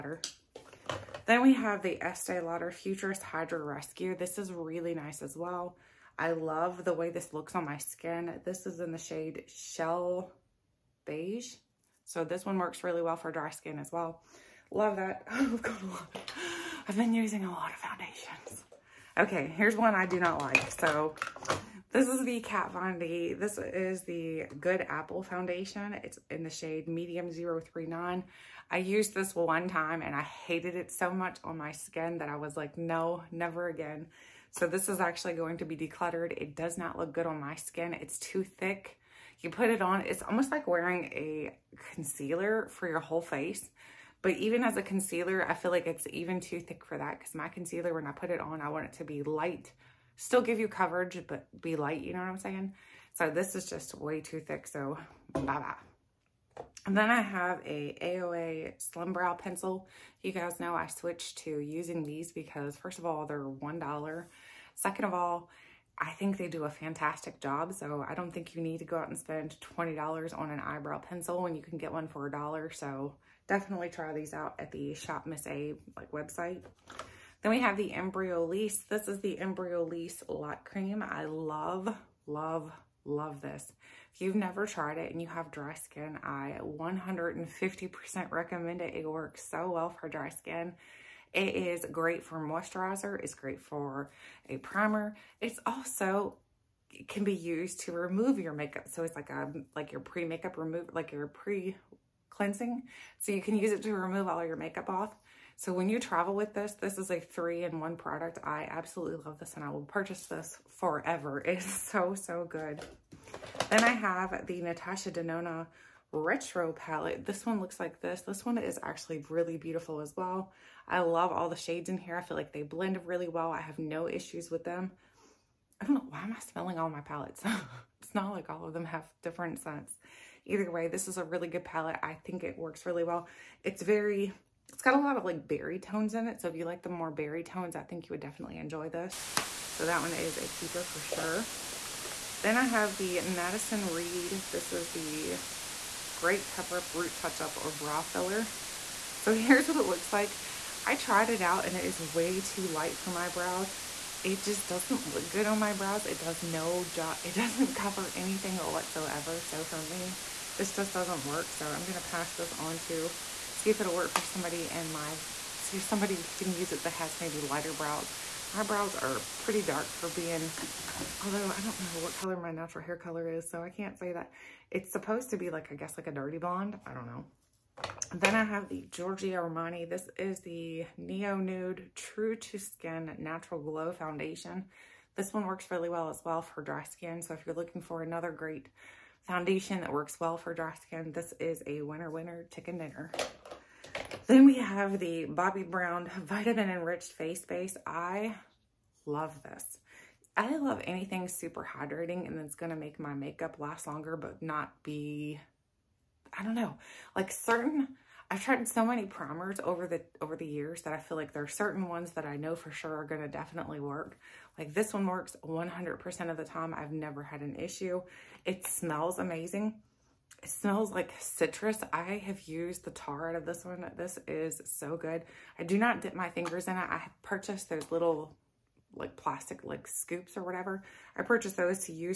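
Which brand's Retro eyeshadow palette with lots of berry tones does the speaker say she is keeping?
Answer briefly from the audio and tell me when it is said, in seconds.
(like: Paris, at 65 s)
Natasha Denona, at 114 s.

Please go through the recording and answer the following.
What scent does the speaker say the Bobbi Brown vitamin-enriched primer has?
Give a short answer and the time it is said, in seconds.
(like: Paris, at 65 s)
Citrus, at 221 s.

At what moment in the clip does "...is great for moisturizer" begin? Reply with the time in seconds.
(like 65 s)
91 s.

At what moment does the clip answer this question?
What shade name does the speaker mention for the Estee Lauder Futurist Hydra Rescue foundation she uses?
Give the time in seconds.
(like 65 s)
9 s.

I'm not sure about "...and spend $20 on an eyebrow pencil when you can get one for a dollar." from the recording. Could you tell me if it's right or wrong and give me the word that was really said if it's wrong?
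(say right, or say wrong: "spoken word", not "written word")
right.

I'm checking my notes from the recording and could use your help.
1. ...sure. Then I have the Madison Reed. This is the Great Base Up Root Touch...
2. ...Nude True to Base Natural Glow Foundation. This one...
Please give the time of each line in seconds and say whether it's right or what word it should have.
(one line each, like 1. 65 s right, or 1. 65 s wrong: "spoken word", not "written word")
1. 141 s wrong: "Cover", not "Base"
2. 181 s wrong: "Skin", not "Base".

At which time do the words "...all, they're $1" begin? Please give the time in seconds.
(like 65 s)
63 s.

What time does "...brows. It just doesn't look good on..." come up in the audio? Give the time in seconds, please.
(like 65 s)
153 s.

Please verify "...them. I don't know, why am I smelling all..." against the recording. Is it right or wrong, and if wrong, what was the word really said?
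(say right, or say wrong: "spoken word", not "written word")
right.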